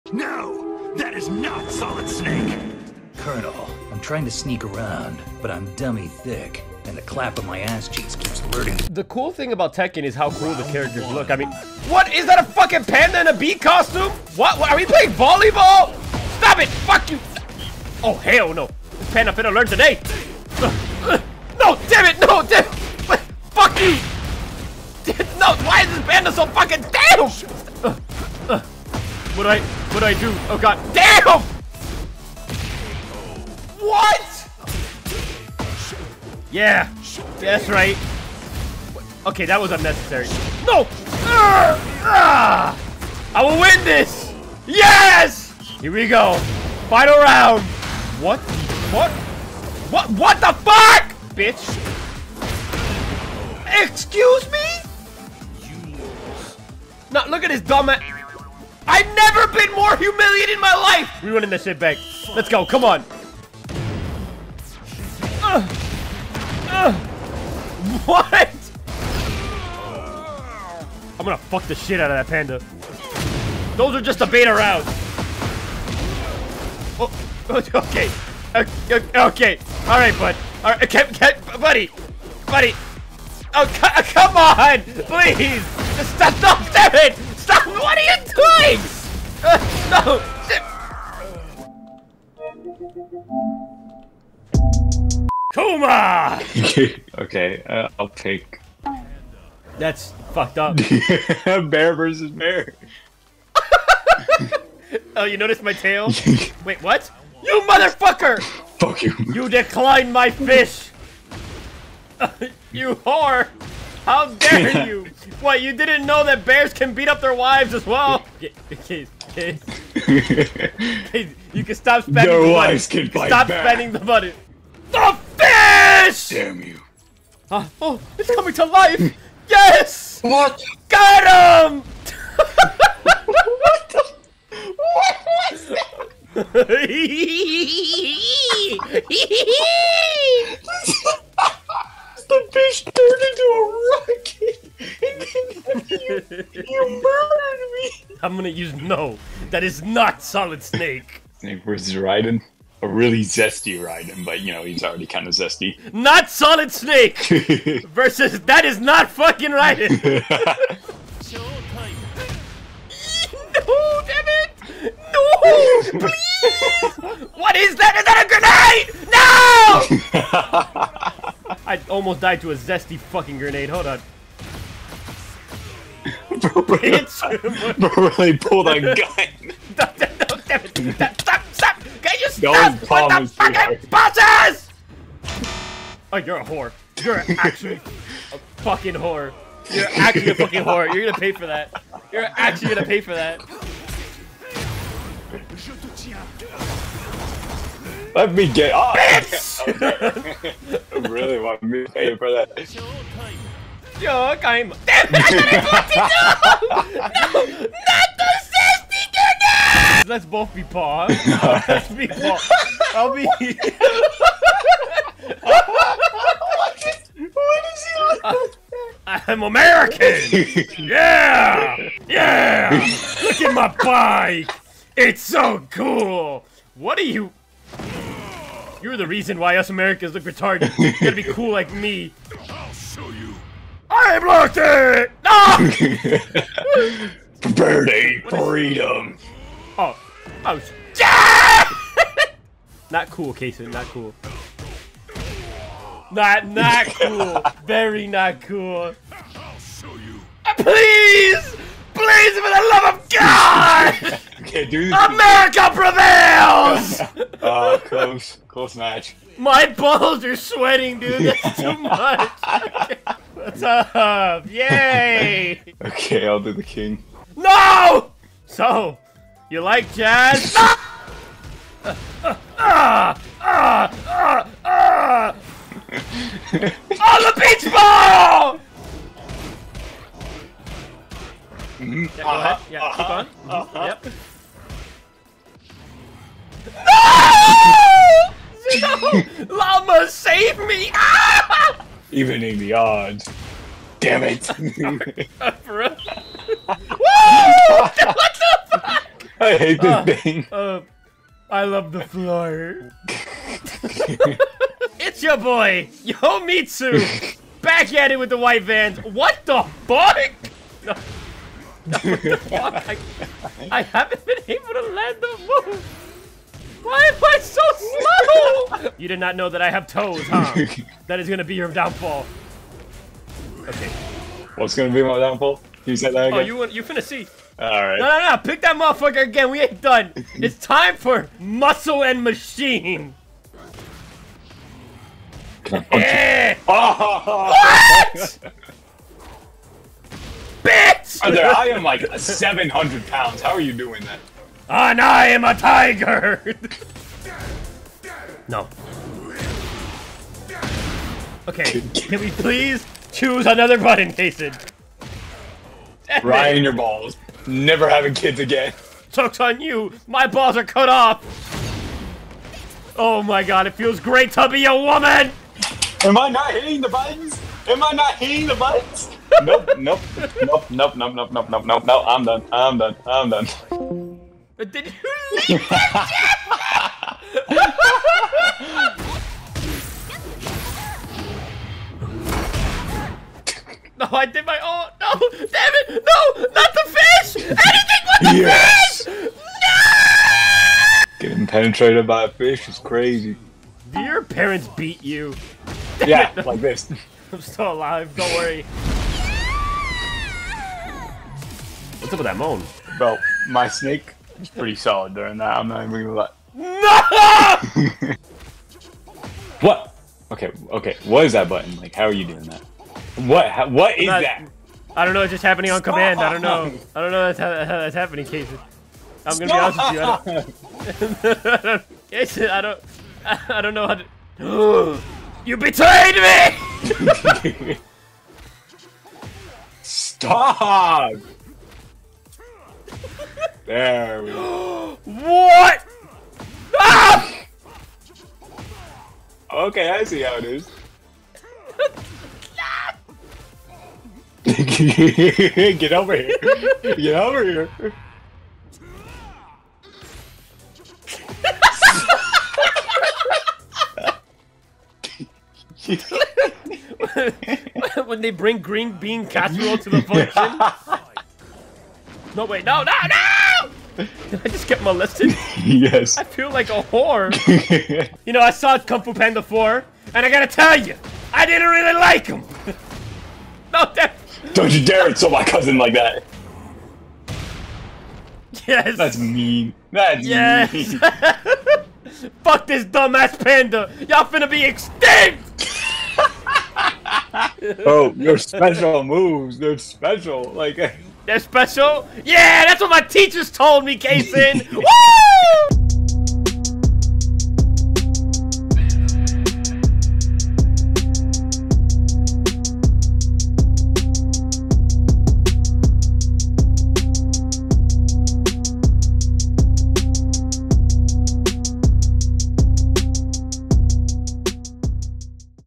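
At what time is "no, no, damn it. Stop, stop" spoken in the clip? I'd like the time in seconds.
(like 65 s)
179 s.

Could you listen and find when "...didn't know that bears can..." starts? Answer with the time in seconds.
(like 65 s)
115 s.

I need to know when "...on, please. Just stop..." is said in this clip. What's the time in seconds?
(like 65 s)
84 s.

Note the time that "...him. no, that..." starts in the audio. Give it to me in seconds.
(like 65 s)
472 s.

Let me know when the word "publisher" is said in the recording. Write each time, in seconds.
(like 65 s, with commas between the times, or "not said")
not said.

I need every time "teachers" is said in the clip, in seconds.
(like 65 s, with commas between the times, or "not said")
493 s.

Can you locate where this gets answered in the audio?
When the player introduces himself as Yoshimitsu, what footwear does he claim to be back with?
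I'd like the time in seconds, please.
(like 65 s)
308 s.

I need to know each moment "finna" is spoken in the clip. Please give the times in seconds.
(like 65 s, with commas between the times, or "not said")
19 s, 326 s, 484 s.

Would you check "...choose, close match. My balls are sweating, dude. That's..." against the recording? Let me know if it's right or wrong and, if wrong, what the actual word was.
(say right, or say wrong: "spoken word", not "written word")
wrong: "close", not "choose".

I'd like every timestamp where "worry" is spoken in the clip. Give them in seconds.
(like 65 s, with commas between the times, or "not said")
398 s.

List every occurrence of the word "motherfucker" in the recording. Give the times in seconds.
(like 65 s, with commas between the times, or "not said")
107 s, 328 s.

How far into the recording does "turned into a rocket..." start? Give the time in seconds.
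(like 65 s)
142 s.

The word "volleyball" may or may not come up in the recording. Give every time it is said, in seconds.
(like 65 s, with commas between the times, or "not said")
15 s.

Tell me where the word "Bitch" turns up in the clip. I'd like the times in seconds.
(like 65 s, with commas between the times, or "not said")
51 s, 340 s.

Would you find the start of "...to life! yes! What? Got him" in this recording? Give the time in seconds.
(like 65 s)
128 s.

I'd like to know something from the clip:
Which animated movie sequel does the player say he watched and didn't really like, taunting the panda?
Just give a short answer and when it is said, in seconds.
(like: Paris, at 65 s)
Kung Fu Panda 4, at 468 s.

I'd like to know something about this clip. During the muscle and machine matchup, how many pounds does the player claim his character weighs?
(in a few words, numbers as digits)
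700 pounds.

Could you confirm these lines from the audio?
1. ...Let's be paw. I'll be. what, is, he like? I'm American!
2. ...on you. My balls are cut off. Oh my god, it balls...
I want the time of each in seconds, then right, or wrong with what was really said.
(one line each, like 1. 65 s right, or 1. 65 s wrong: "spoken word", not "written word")
1. 211 s right
2. 359 s wrong: "feels", not "balls".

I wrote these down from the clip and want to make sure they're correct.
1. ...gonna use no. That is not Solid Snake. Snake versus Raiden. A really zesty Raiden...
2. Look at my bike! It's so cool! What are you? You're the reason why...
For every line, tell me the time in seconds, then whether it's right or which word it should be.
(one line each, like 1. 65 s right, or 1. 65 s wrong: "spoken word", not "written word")
1. 148 s right
2. 223 s right.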